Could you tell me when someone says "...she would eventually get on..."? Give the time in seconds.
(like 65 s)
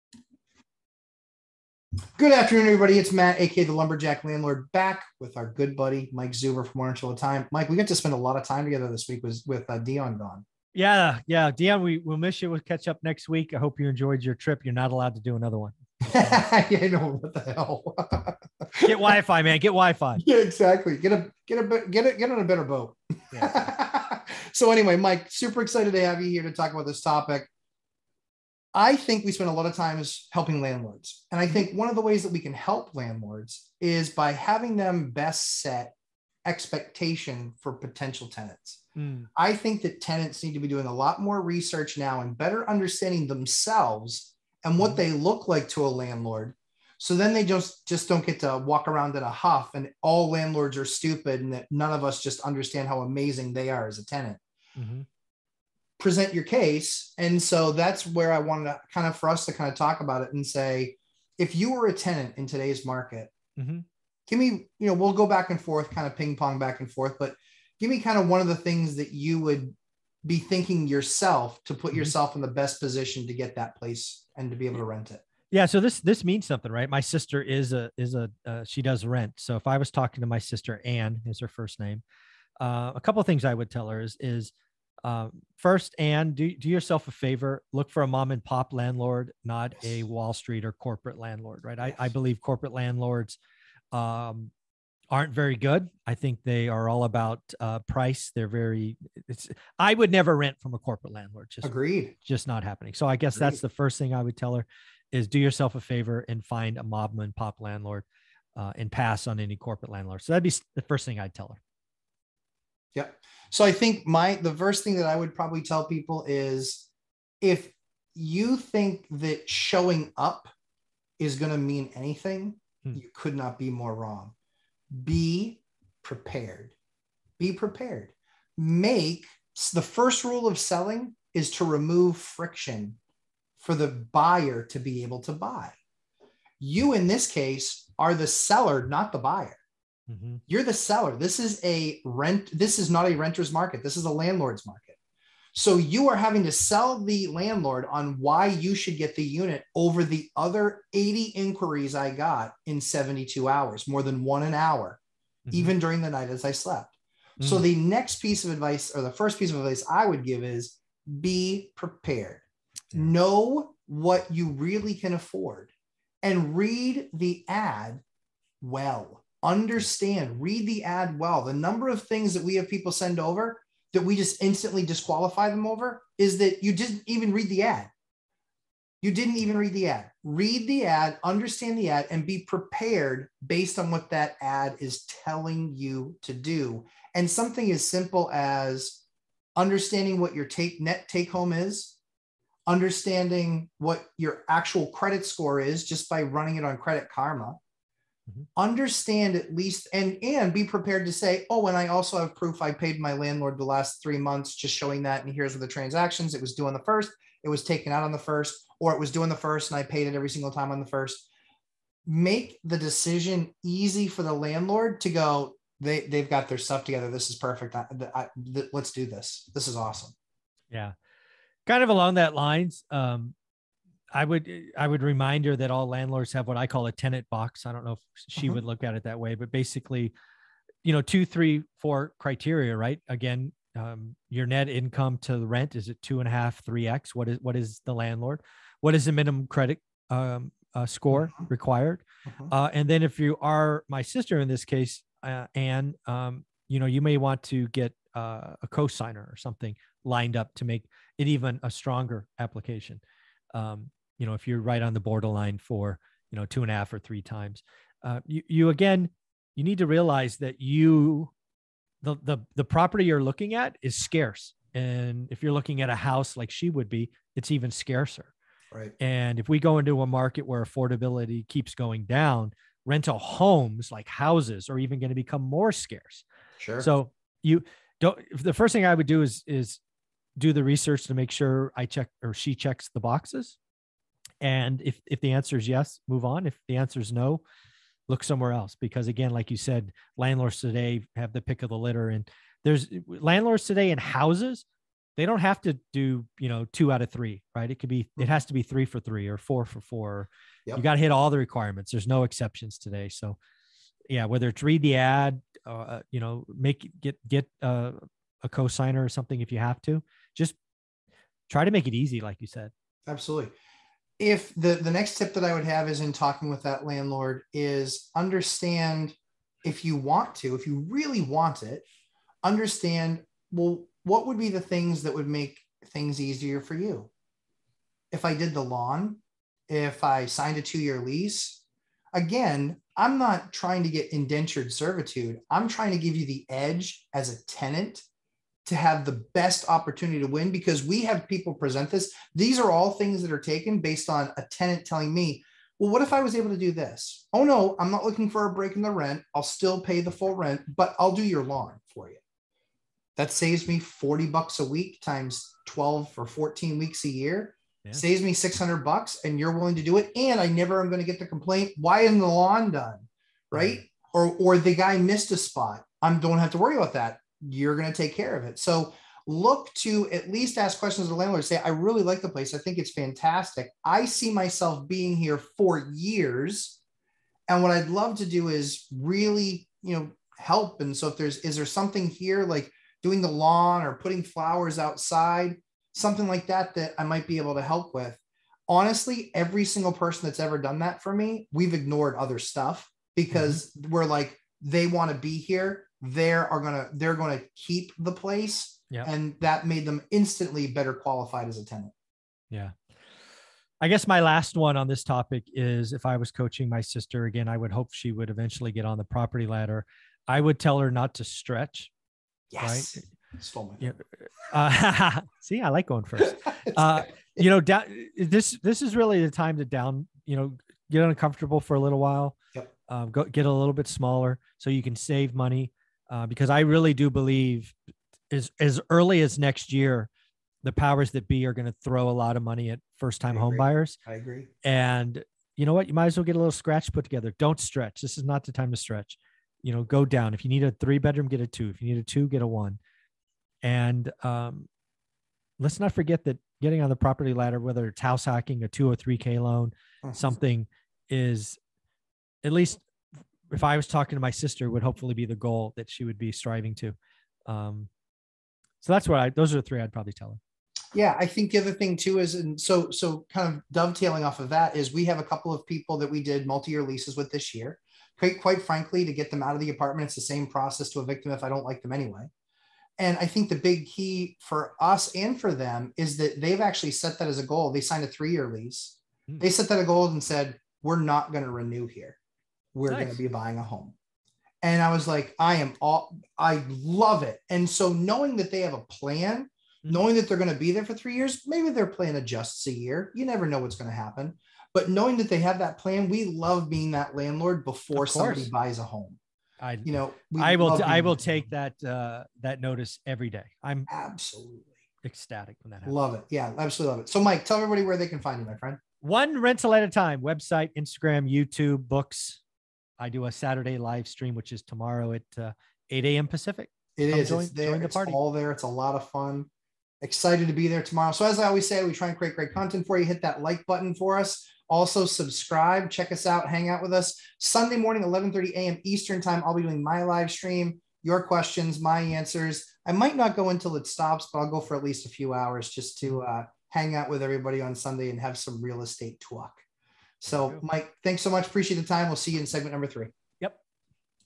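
407 s.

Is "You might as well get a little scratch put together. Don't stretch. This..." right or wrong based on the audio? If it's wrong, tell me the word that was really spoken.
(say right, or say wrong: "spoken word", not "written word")
right.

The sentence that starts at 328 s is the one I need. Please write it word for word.
If I did the lawn, if I signed a two year lease, again, I'm not trying to get indentured servitude.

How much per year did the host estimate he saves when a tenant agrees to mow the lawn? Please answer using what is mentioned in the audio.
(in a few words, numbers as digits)
$600.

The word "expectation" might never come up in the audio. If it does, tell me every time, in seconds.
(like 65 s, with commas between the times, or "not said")
36 s.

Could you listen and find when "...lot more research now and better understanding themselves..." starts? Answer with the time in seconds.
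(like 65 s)
40 s.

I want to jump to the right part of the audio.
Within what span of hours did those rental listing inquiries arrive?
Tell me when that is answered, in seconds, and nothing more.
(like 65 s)
152 s.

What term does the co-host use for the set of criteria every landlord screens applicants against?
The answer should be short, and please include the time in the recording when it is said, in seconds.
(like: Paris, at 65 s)
tenant box, at 226 s.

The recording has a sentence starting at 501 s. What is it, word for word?
that, uh, that notice every day.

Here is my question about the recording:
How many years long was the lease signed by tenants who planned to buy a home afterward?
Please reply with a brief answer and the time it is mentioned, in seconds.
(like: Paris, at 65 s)
3, at 478 s.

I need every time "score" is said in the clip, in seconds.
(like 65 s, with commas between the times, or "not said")
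195 s, 240 s.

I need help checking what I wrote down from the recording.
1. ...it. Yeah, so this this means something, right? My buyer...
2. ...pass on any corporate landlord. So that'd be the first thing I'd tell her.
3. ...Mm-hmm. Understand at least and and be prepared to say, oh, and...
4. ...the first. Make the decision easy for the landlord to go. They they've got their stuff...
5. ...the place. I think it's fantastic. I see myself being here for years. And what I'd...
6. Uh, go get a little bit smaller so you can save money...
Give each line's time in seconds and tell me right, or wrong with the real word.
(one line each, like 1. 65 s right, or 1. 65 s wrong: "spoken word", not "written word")
1. 75 s wrong: "sister", not "buyer"
2. 108 s right
3. 198 s right
4. 210 s right
5. 372 s right
6. 422 s right.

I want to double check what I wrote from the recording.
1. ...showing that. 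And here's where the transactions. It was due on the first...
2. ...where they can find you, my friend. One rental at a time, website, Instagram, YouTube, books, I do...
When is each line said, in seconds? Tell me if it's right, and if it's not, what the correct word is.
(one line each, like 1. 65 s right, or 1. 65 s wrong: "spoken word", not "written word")
1. 204 s right
2. 507 s right.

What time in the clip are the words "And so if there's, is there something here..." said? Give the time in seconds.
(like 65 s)
380 s.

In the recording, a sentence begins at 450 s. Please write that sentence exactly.
something is at least if I was talking to my sister, would hopefully be the goal that she would be striving to.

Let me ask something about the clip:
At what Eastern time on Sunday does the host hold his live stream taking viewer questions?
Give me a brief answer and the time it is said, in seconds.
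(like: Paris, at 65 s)
11:30 a.m., at 528 s.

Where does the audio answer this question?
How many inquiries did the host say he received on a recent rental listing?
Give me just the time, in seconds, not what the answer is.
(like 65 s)
150 s.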